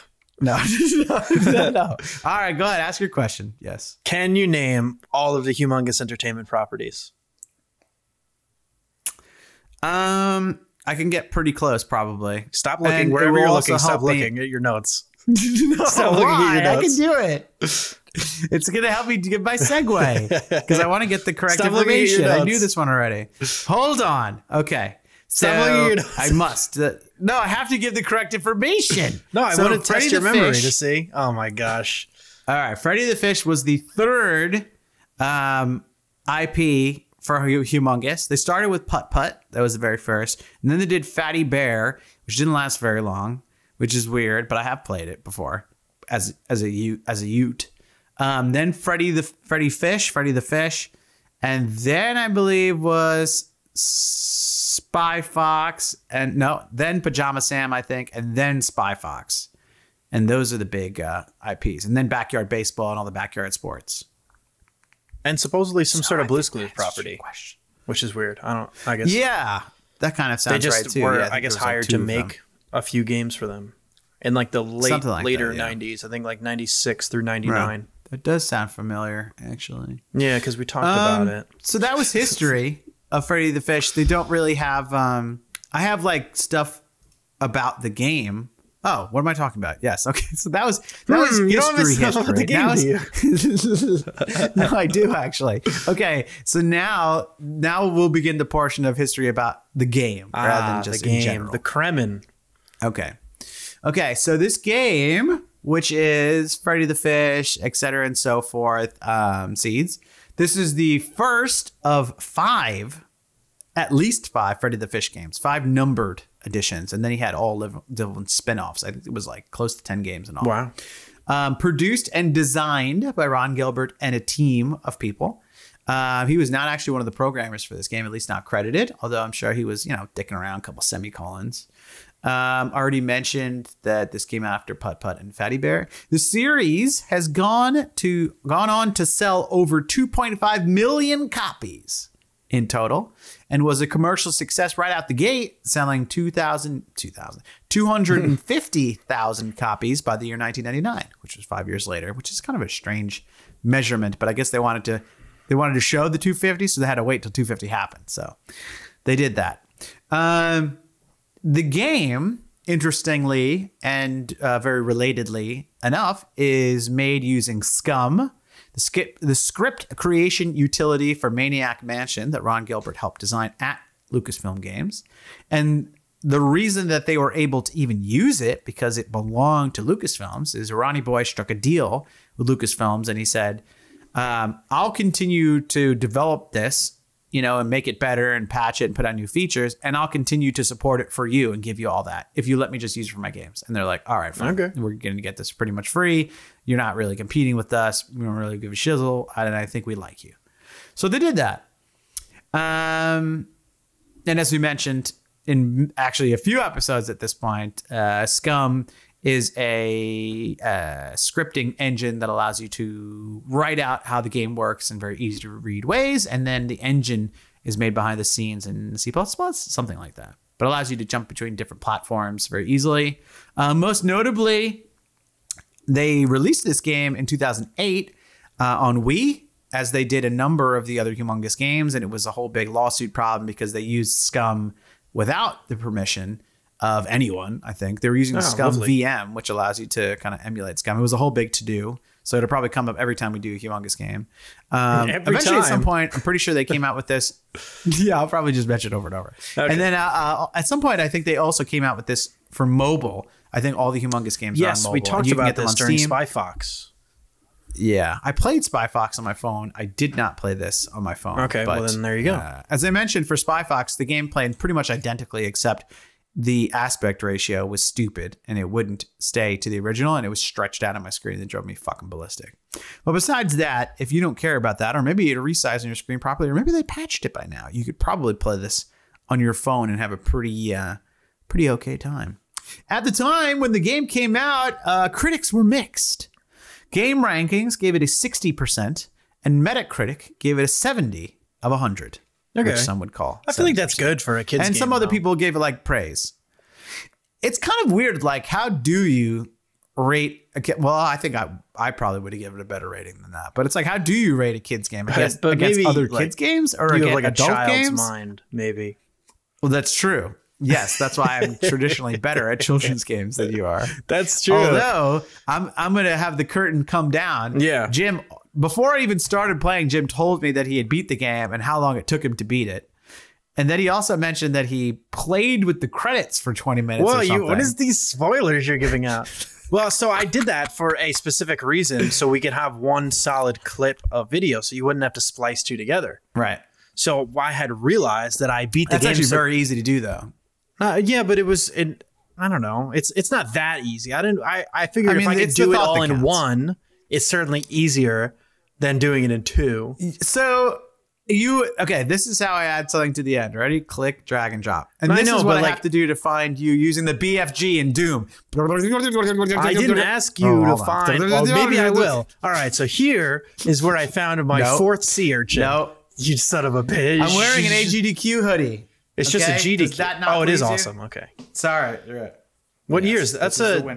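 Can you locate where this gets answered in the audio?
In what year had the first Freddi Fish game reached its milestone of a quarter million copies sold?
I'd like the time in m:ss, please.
2:30.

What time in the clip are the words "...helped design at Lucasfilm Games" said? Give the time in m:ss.
2:52.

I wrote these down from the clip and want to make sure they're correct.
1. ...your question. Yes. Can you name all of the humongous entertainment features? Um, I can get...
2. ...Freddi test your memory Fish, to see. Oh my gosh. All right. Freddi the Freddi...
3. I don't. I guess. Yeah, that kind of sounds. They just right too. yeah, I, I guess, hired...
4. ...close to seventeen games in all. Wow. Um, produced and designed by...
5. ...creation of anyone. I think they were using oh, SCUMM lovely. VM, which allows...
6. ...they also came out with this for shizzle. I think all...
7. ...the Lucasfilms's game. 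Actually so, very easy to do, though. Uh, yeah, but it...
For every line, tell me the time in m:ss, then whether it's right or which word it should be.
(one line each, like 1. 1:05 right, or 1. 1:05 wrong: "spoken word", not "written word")
1. 0:02 wrong: "properties", not "features"
2. 0:29 wrong: "Fish", not "Freddi"
3. 1:08 right
4. 1:59 wrong: "ten", not "seventeen"
5. 3:55 wrong: "permission", not "creation"
6. 4:11 wrong: "mobile", not "shizzle"
7. 5:38 wrong: "That", not "Lucasfilms".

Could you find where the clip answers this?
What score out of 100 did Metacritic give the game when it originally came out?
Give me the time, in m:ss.
4:50.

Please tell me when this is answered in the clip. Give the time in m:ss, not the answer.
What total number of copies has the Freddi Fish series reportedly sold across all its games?
2:19.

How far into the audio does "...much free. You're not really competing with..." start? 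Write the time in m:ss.
3:15.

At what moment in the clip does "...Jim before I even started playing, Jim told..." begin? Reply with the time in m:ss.
5:17.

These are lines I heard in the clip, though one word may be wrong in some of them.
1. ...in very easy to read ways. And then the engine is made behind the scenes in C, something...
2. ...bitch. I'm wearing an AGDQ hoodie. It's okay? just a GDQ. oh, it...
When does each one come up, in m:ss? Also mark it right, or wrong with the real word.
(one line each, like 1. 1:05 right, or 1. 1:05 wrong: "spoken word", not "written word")
1. 3:34 right
2. 6:06 right.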